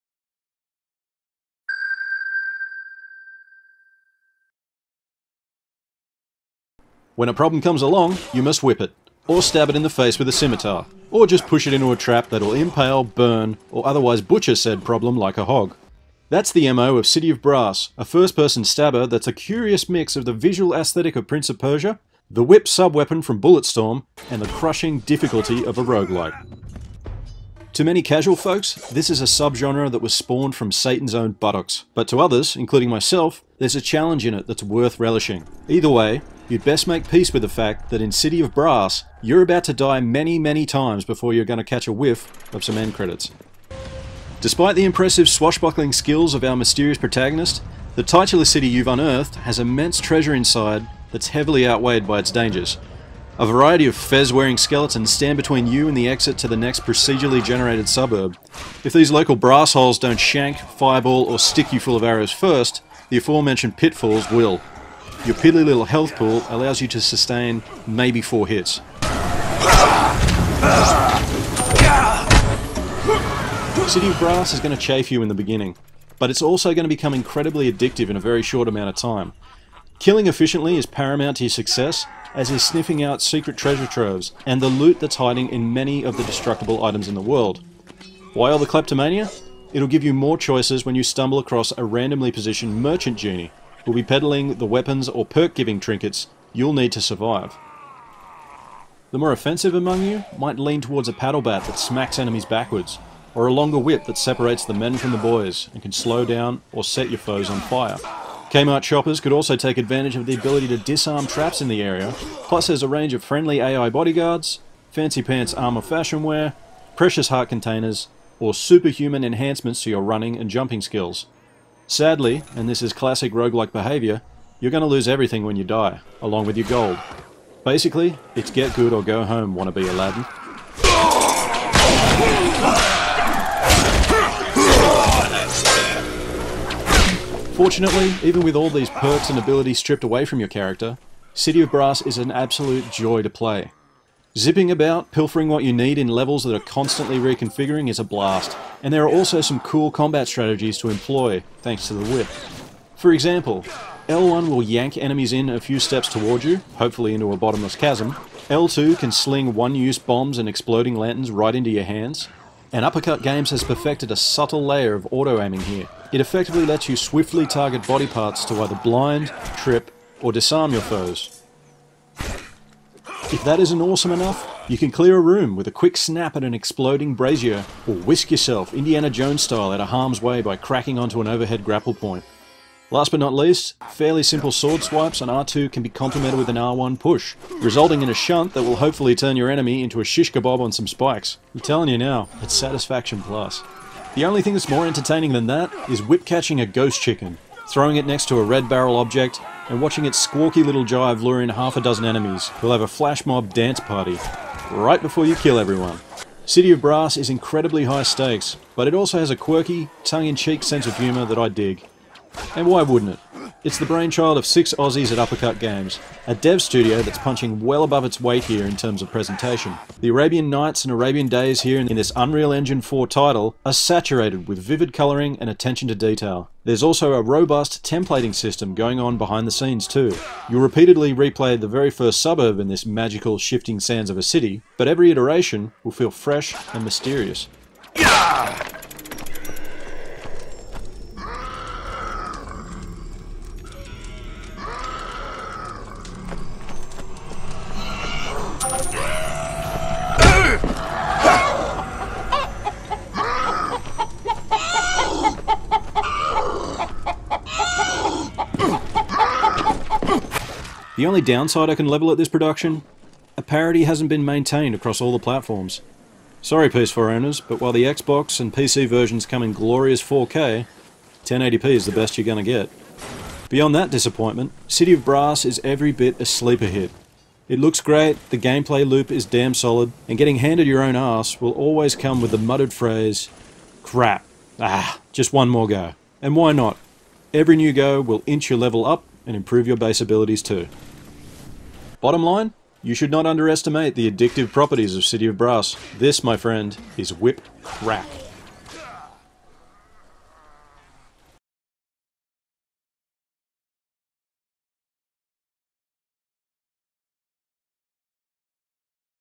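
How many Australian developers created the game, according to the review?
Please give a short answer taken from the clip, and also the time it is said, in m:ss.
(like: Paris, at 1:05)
6, at 3:34.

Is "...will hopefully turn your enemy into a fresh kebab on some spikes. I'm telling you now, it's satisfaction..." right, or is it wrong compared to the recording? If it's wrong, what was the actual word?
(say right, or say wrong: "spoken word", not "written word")
wrong: "shish", not "fresh".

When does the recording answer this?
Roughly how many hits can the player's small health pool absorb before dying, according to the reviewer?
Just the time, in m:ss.
1:08.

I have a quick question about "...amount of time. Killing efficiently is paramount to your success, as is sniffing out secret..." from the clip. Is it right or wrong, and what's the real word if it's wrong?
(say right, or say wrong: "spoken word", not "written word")
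right.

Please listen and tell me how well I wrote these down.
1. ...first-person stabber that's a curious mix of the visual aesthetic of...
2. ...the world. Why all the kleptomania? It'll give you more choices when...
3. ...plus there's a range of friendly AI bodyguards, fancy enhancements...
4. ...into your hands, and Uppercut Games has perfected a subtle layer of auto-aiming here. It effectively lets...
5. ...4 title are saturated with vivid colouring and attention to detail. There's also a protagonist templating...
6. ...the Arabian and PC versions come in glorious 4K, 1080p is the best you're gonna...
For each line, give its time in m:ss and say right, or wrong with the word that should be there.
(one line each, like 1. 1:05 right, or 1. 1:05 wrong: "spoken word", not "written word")
1. 0:18 right
2. 1:27 right
3. 1:52 wrong: "pants", not "enhancements"
4. 2:41 right
5. 3:42 wrong: "robust", not "protagonist"
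6. 4:27 wrong: "Xbox", not "Arabian".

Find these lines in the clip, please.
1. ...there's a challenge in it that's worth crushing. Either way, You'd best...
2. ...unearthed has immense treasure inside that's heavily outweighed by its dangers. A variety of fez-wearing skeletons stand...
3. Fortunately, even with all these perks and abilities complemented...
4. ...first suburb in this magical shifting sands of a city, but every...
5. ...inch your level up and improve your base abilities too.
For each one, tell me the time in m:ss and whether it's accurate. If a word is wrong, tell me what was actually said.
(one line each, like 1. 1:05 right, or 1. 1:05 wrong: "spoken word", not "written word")
1. 0:33 wrong: "relishing", not "crushing"
2. 0:48 right
3. 2:17 wrong: "stripped", not "complemented"
4. 3:51 right
5. 4:48 right.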